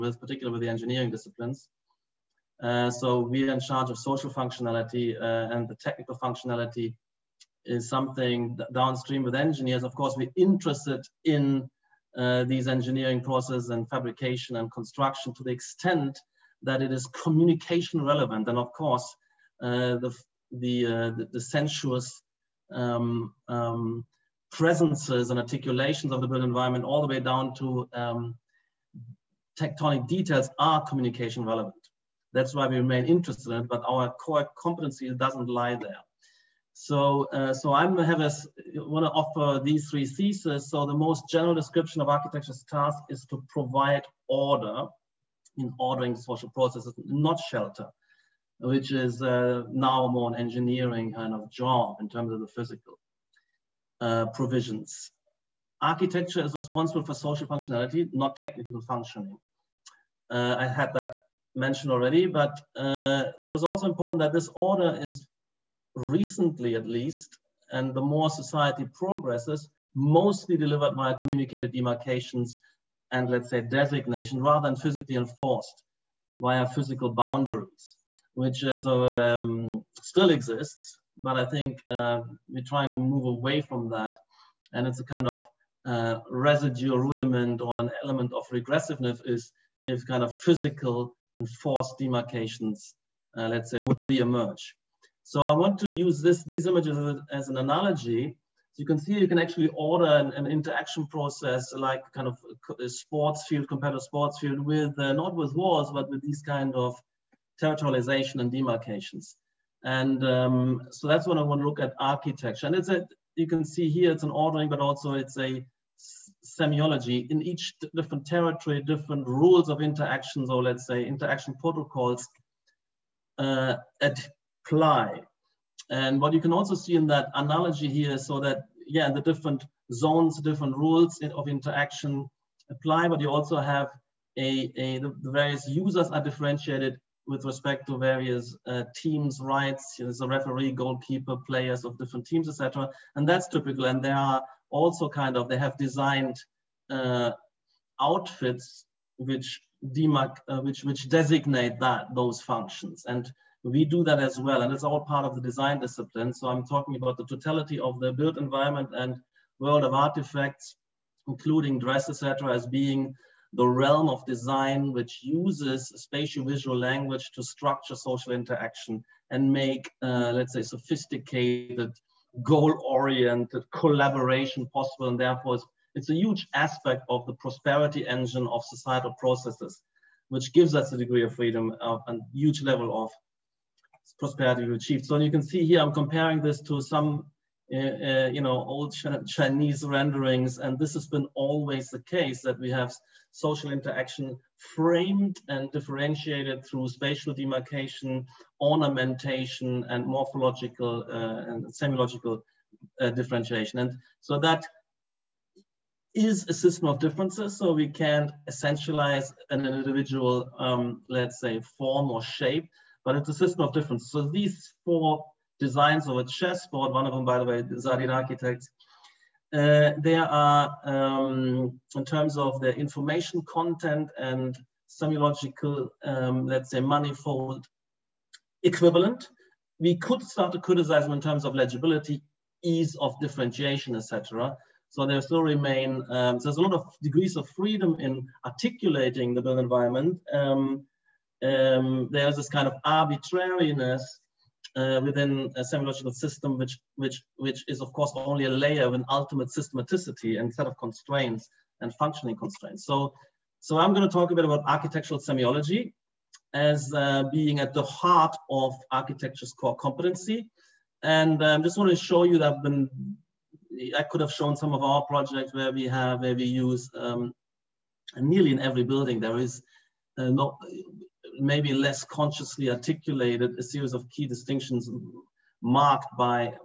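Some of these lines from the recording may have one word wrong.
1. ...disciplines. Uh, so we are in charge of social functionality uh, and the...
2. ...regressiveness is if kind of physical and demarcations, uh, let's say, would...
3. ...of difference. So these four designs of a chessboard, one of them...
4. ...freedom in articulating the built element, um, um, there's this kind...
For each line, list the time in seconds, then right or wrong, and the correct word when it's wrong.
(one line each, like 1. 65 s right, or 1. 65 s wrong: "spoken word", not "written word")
1. 1 s right
2. 88 s right
3. 213 s right
4. 237 s wrong: "environment", not "element".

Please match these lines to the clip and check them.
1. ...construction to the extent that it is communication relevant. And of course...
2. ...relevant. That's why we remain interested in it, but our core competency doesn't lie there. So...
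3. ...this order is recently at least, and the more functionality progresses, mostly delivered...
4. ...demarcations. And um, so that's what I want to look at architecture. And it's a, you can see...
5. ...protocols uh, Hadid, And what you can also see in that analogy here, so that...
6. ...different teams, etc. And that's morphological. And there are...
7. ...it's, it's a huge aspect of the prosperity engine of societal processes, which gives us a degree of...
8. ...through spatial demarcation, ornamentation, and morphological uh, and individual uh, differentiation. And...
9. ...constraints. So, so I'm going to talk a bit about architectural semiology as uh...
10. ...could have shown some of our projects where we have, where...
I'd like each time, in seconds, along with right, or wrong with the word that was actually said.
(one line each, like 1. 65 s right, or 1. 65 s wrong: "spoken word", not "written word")
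1. 14 s right
2. 31 s right
3. 64 s wrong: "society", not "functionality"
4. 108 s right
5. 121 s wrong: "Apply", not "Hadid"
6. 141 s wrong: "typical", not "morphological"
7. 175 s right
8. 196 s wrong: "semiological", not "individual"
9. 252 s right
10. 264 s right.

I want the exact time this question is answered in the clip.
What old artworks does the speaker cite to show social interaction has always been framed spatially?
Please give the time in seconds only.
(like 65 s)
189 s.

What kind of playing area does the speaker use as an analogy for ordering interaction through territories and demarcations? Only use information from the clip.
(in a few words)
Competitive sports field.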